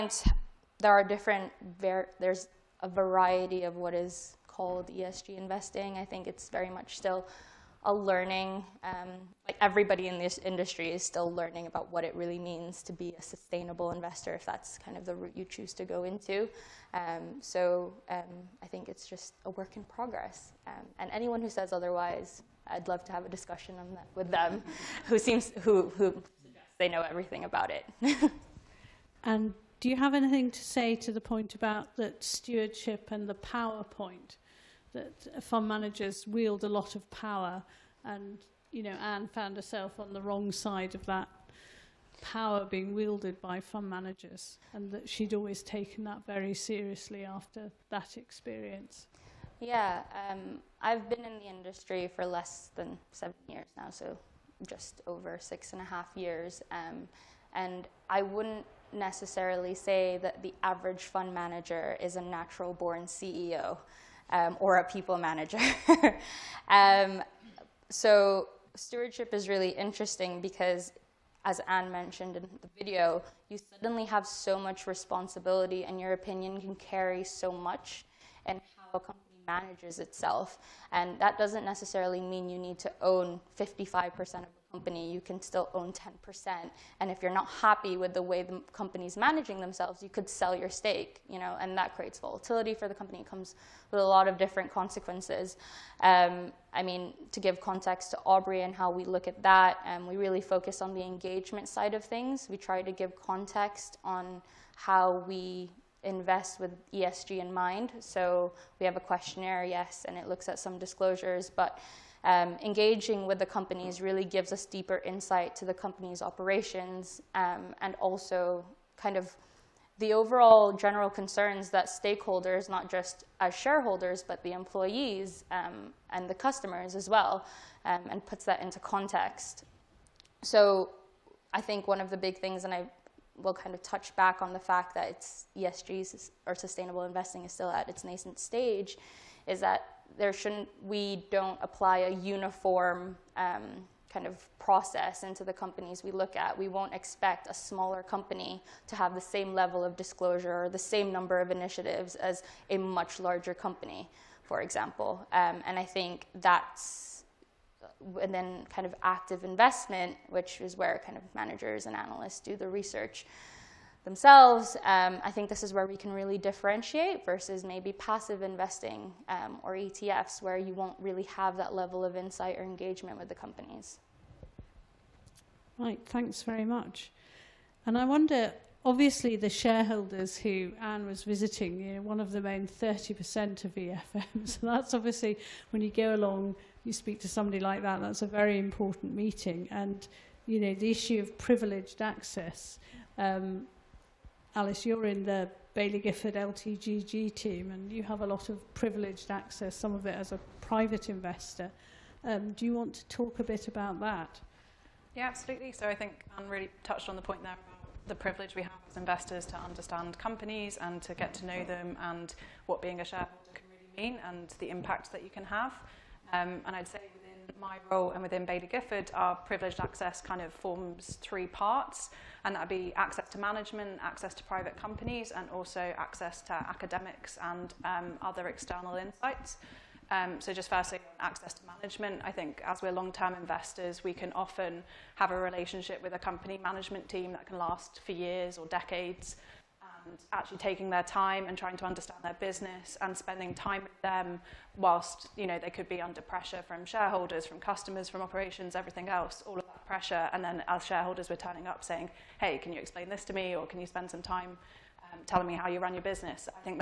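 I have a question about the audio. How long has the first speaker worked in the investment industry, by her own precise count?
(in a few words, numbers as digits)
just over 6.5 years.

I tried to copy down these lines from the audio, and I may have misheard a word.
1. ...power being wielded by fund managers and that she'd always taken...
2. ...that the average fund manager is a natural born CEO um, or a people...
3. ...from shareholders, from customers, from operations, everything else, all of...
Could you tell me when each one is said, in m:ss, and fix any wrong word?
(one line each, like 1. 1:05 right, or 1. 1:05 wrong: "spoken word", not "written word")
1. 0:42 right
2. 1:00 right
3. 4:06 right.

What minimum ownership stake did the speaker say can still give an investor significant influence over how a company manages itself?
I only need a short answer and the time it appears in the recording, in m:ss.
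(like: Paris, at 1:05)
10%, at 1:25.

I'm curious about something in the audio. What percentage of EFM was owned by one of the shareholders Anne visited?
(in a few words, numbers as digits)
30%.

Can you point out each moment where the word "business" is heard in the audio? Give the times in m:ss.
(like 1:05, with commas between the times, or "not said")
4:02, 4:16.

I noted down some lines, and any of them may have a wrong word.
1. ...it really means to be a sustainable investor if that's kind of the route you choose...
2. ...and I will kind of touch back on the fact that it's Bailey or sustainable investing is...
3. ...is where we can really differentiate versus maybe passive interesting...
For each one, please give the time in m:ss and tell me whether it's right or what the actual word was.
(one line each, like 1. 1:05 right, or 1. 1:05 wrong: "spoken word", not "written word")
1. 0:12 right
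2. 2:12 wrong: "ESG", not "Bailey"
3. 2:45 wrong: "investing", not "interesting".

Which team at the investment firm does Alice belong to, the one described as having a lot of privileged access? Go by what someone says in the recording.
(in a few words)
LTGG.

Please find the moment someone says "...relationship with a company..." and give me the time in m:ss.
3:55.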